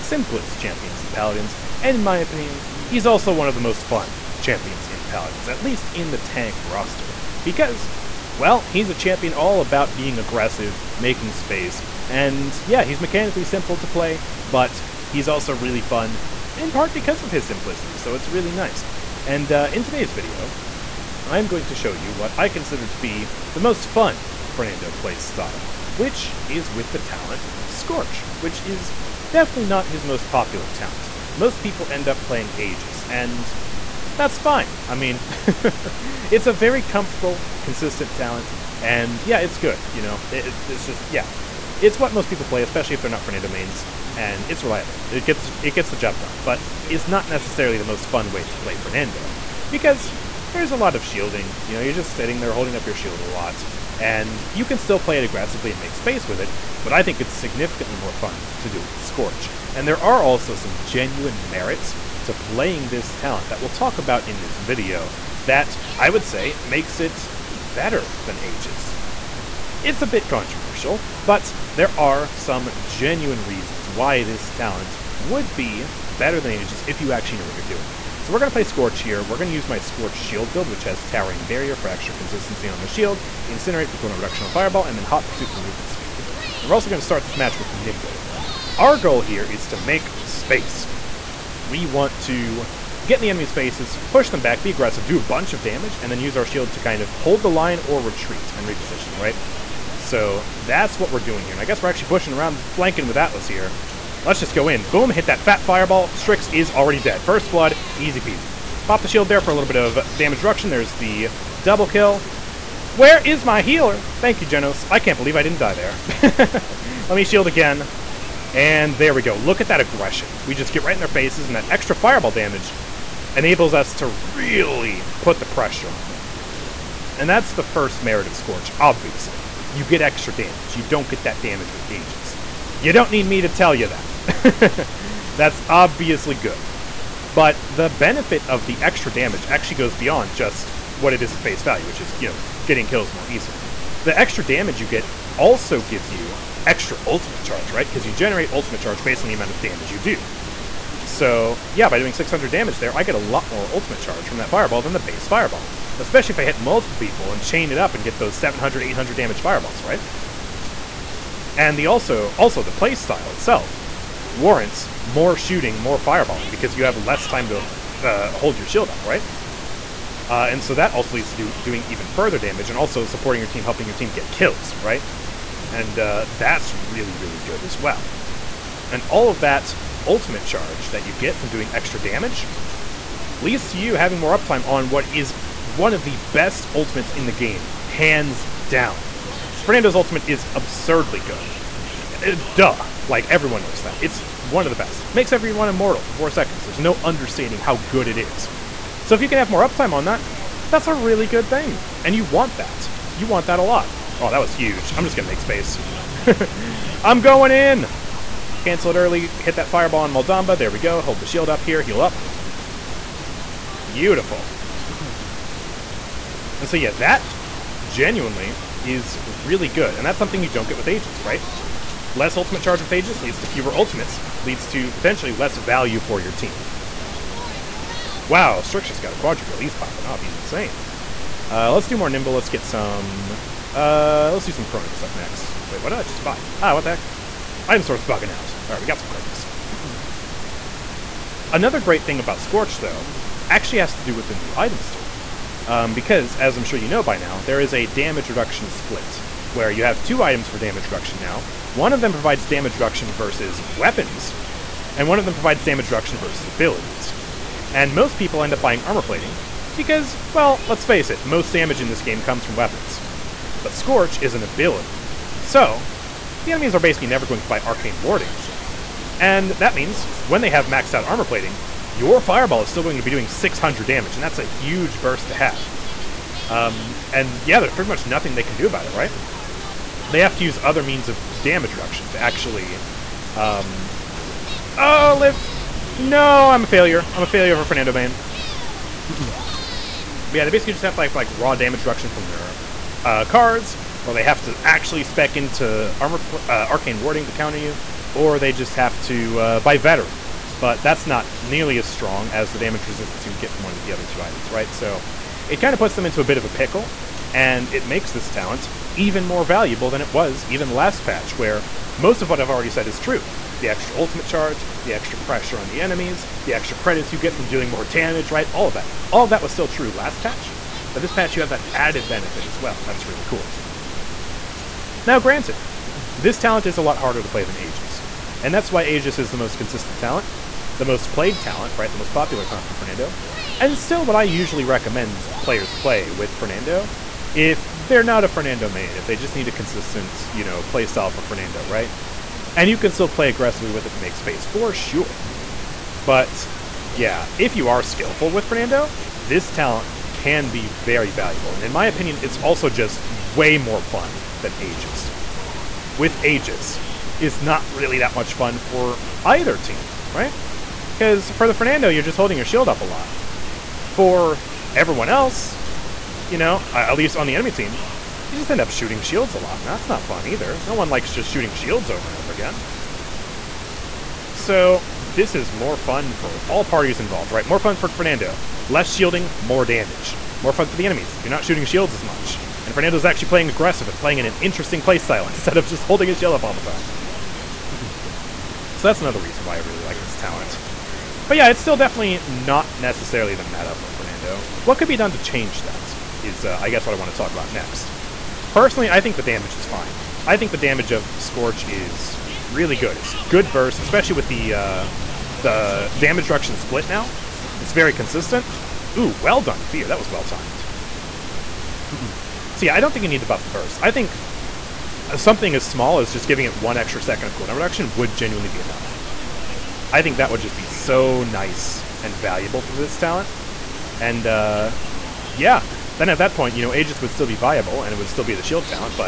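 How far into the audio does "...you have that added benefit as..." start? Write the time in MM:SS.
05:21.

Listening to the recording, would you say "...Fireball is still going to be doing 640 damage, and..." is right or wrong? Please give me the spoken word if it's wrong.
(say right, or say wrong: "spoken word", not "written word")
wrong: "600", not "640".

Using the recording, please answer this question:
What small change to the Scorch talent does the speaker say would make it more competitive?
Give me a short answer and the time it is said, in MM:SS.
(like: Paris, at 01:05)
1 extra second of cooldown reduction, at 06:56.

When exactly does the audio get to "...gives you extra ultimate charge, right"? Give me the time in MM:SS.
02:25.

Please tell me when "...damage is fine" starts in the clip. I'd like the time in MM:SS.
06:39.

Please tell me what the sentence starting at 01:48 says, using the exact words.
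Pop the shield there for a little bit of damage reduction.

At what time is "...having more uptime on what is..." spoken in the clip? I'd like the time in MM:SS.
03:03.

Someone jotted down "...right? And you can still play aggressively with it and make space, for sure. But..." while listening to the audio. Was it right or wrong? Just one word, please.
right.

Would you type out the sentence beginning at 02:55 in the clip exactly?
And uh, that's really, really good as well.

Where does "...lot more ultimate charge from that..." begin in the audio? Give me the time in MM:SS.
02:33.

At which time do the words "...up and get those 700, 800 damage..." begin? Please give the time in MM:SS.
02:37.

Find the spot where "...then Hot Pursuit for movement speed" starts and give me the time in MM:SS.
01:24.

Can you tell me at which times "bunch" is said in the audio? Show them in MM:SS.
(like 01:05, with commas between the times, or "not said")
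01:35.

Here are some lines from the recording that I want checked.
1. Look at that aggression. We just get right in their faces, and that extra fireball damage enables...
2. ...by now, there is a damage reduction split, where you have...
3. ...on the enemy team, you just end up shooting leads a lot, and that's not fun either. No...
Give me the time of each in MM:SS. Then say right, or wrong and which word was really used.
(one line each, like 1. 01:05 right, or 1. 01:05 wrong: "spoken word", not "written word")
1. 01:59 right
2. 04:07 right
3. 06:07 wrong: "shields", not "leads".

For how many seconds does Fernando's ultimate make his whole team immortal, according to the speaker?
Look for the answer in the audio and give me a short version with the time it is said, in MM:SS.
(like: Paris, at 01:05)
4, at 03:16.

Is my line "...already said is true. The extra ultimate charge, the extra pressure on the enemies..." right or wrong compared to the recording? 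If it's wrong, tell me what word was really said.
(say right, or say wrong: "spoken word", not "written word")
right.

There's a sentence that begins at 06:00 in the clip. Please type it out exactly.
Because for the Fernando, you're just holding your shield up a lot.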